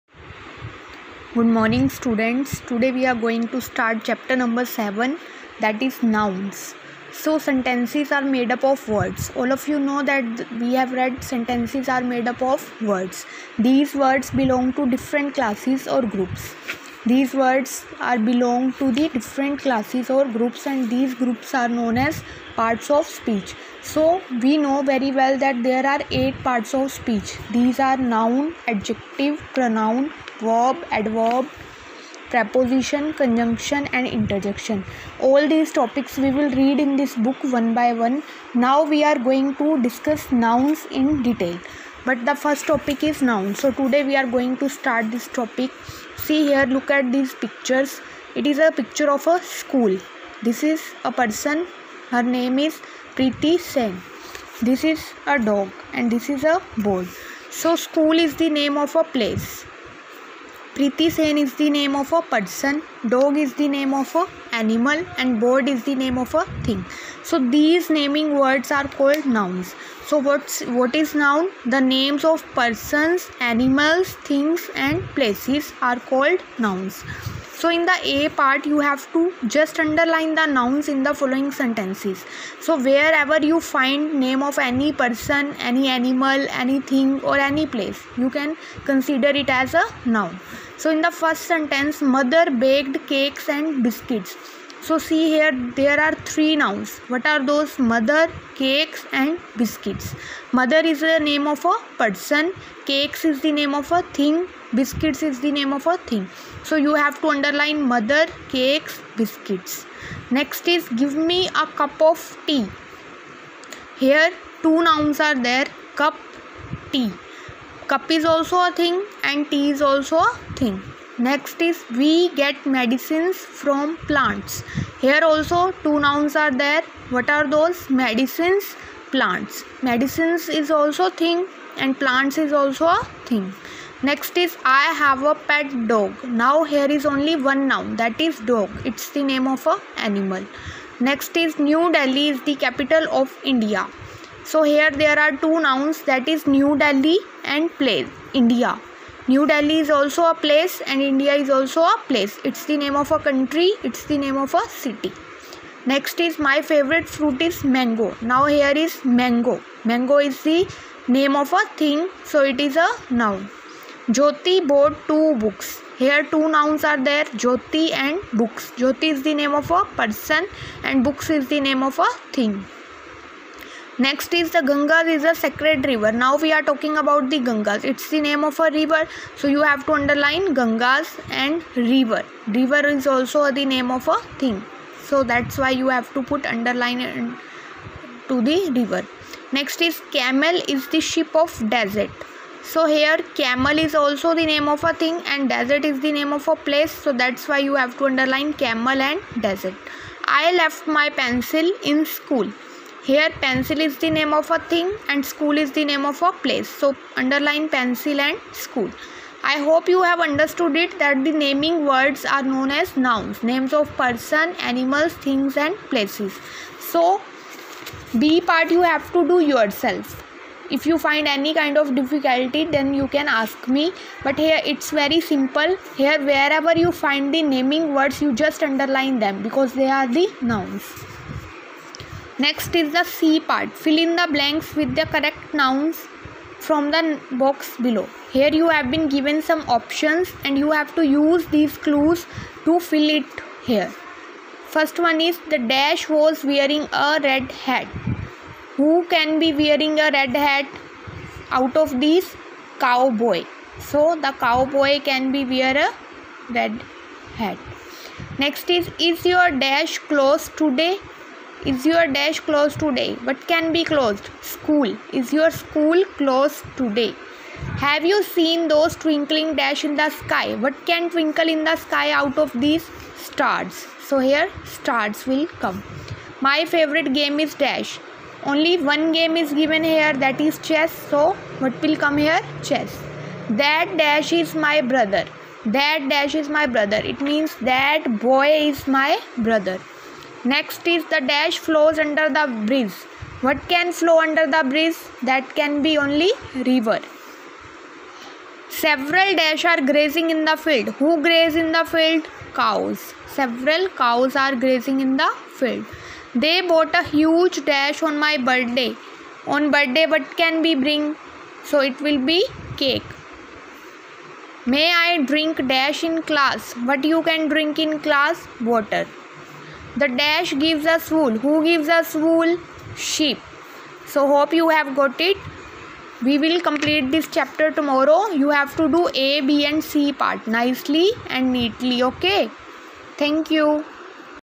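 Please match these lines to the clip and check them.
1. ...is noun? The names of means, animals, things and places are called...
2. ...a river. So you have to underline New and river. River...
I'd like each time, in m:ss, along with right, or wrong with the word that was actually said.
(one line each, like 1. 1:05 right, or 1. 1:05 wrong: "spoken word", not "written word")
1. 1:10 wrong: "persons", not "means"
2. 2:58 wrong: "Gangas", not "New".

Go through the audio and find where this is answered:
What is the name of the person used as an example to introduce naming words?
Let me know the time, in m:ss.
0:53.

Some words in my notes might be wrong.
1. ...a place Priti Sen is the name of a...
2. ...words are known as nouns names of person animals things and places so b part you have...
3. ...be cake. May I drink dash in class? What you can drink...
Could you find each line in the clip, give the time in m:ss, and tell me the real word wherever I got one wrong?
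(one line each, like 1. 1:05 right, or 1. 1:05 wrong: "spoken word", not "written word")
1. 0:58 right
2. 3:31 right
3. 5:12 right.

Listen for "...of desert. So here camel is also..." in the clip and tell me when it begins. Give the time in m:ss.
3:11.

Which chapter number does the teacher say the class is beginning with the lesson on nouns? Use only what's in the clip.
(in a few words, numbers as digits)
7.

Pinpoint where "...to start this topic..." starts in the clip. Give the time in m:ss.
0:44.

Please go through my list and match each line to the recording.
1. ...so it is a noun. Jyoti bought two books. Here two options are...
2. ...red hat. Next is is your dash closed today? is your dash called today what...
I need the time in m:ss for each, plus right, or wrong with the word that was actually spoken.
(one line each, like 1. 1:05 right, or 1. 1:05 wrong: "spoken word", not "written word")
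1. 2:42 wrong: "nouns", not "options"
2. 4:16 wrong: "closed", not "called".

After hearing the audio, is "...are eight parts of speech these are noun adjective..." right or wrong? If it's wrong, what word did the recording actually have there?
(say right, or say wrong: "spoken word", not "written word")
right.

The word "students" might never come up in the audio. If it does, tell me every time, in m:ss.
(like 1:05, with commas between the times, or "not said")
0:01.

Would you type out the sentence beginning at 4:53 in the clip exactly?
What can flow under the bridge?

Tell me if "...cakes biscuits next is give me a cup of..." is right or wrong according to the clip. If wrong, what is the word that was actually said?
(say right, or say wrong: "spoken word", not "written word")
right.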